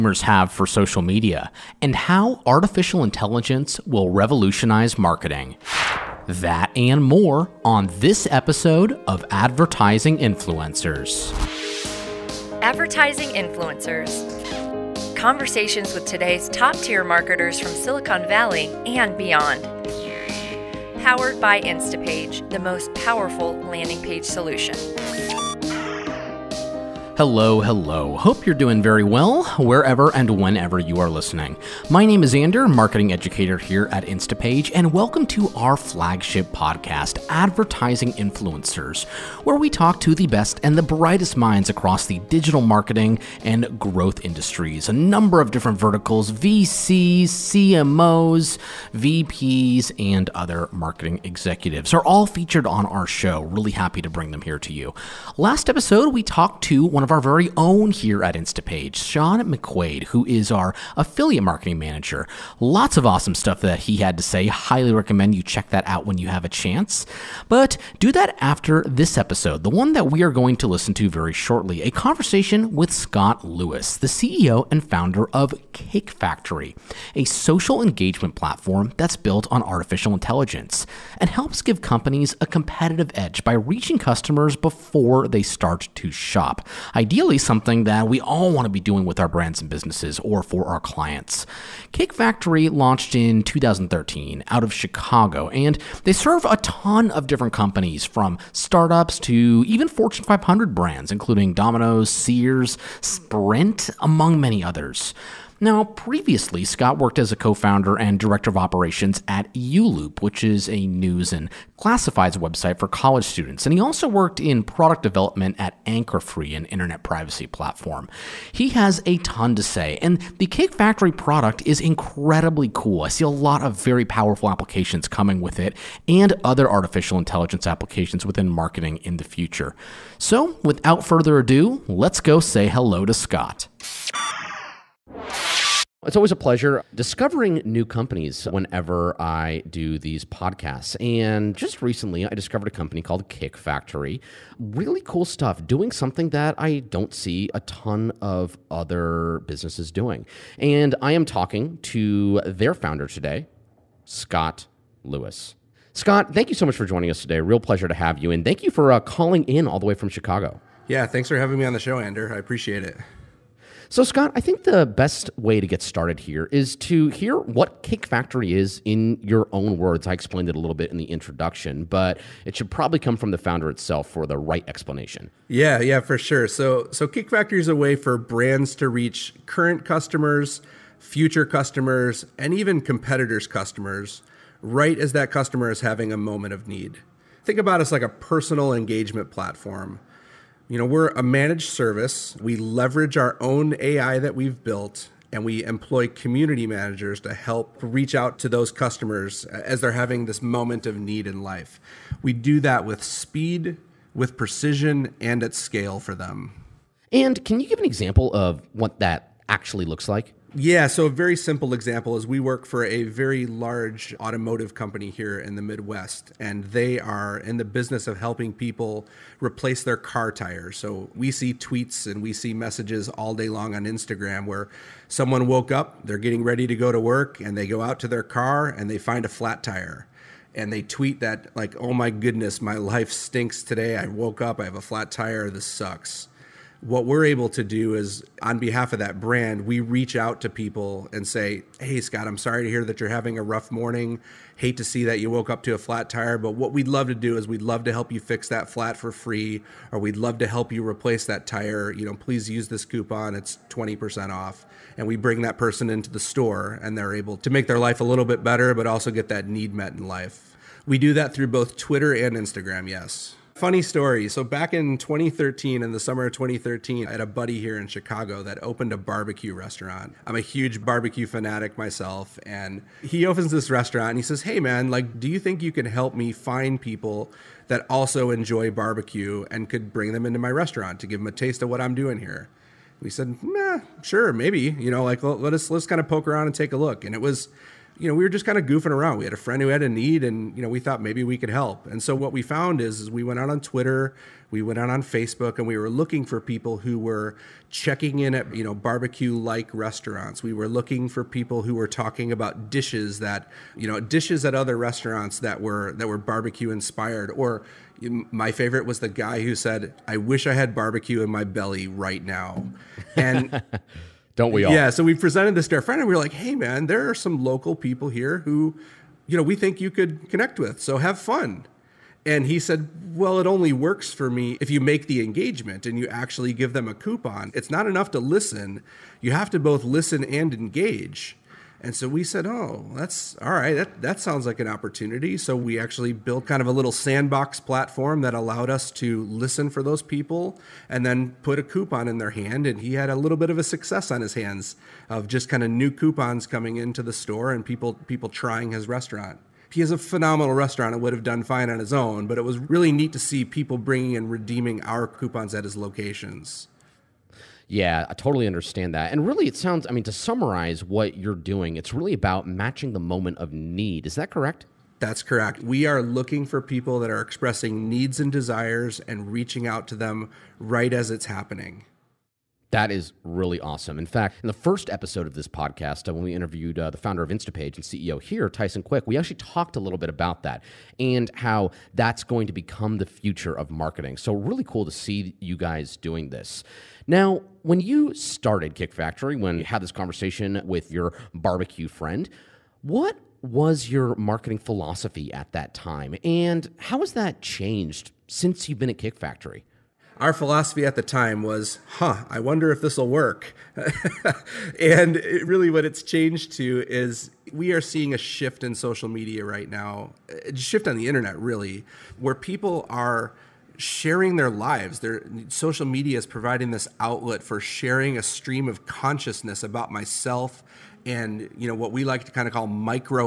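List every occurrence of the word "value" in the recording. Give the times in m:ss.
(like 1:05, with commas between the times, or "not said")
not said.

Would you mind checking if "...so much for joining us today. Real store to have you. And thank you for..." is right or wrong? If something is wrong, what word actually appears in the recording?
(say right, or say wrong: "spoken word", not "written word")
wrong: "pleasure", not "store".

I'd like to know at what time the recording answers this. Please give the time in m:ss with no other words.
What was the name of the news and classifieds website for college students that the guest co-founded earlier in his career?
1:49.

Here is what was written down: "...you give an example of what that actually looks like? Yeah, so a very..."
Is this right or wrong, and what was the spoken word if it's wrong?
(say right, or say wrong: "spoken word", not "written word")
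right.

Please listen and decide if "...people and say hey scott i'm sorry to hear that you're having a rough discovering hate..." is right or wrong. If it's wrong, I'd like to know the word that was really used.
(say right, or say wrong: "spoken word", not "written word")
wrong: "morning", not "discovering".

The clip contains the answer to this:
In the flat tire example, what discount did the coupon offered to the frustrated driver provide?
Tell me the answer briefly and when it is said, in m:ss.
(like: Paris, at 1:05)
20% off, at 4:13.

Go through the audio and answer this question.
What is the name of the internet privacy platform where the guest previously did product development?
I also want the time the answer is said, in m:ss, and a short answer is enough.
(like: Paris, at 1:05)
Anchor Free, at 1:55.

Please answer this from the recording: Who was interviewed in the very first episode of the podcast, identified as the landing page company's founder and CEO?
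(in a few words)
Tyson Quick.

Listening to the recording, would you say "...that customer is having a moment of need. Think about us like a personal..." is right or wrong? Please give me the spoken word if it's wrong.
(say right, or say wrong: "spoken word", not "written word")
right.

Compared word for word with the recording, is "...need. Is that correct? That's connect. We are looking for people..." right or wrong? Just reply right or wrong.
wrong.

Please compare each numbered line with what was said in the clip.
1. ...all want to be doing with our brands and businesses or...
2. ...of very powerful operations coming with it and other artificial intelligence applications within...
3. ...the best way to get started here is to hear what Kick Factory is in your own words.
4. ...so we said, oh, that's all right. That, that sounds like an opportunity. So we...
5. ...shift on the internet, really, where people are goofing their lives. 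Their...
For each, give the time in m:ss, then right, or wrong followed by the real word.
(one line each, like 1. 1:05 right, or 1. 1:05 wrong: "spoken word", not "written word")
1. 1:28 right
2. 2:03 wrong: "applications", not "operations"
3. 2:44 right
4. 5:31 right
5. 6:50 wrong: "sharing", not "goofing".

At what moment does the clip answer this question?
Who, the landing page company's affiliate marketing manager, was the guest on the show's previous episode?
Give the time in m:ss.
0:58.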